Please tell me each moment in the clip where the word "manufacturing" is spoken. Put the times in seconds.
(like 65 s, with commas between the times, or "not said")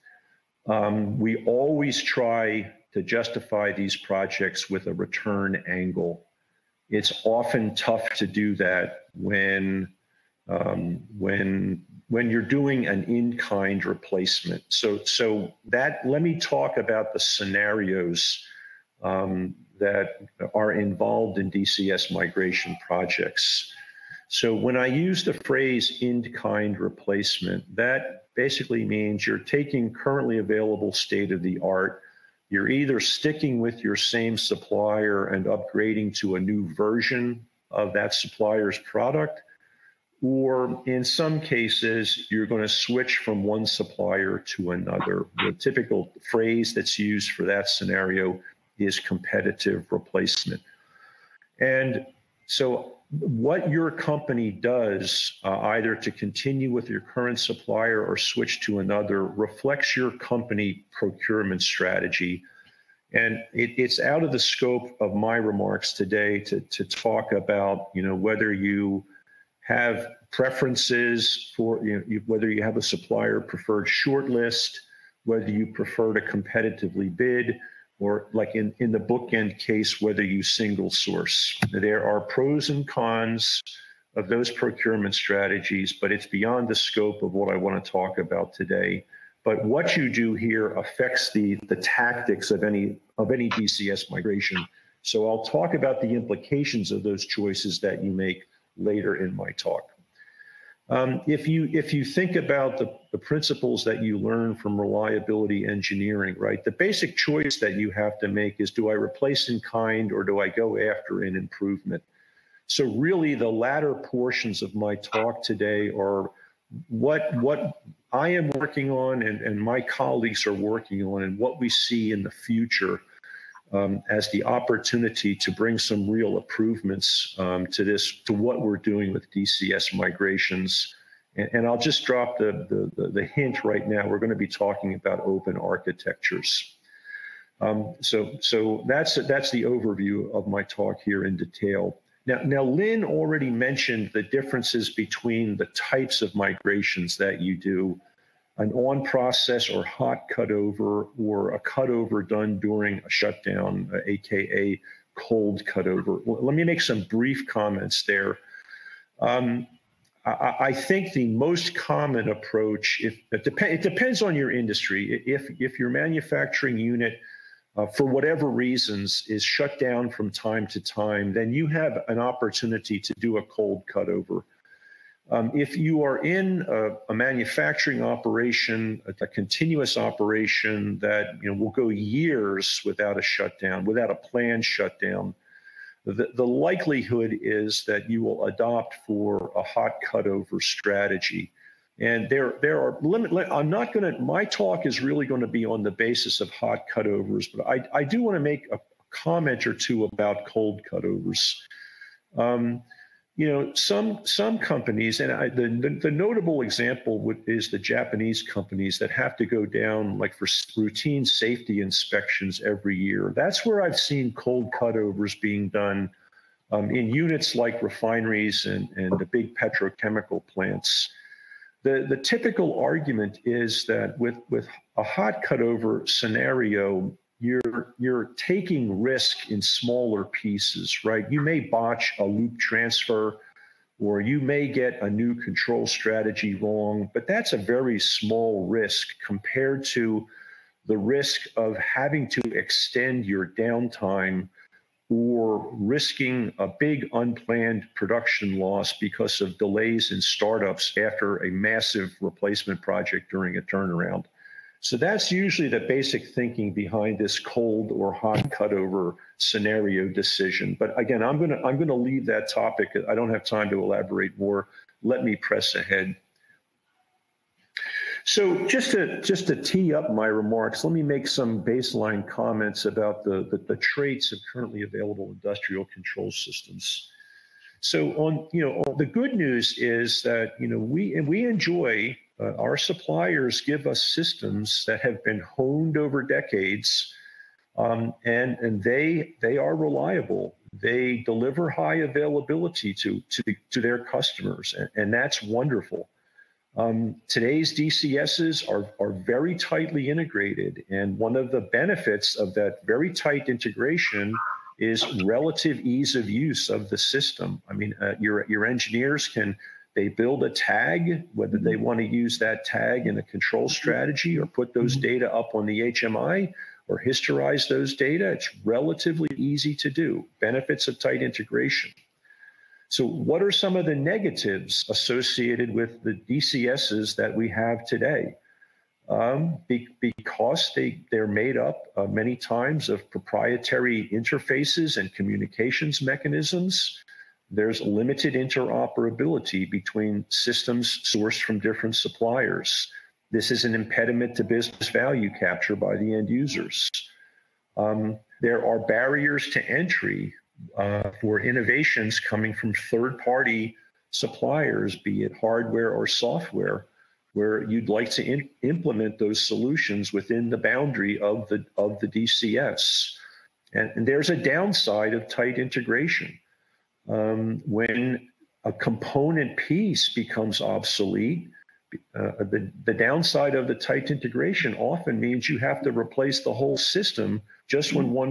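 165 s, 177 s.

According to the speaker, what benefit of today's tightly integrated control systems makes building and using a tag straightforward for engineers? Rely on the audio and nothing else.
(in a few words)
Ease of use.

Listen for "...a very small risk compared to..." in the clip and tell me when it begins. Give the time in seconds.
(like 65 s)
237 s.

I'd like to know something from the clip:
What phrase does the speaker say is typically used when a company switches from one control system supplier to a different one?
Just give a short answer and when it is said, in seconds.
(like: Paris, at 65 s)
Competitive replacement, at 48 s.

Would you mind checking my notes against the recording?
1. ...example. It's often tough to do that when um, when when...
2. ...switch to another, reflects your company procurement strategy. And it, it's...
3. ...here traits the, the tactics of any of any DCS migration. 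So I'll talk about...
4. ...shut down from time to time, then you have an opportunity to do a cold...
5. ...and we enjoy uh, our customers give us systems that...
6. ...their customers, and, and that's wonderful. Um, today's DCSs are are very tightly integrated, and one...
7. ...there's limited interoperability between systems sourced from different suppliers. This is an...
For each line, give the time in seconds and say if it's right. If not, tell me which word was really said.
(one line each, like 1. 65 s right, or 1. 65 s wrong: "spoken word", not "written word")
1. 5 s wrong: "angle", not "example"
2. 58 s right
3. 90 s wrong: "affects", not "traits"
4. 169 s right
5. 281 s wrong: "suppliers", not "customers"
6. 293 s right
7. 337 s right.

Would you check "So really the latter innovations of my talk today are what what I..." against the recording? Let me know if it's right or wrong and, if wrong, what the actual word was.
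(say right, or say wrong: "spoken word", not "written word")
wrong: "portions", not "innovations".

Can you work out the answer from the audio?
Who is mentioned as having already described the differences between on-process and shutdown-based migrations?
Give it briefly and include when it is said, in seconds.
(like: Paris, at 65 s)
Lynn, at 142 s.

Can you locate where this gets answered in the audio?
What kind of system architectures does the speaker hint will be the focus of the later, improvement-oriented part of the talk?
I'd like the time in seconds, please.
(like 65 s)
135 s.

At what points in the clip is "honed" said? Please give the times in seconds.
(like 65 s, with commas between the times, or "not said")
285 s.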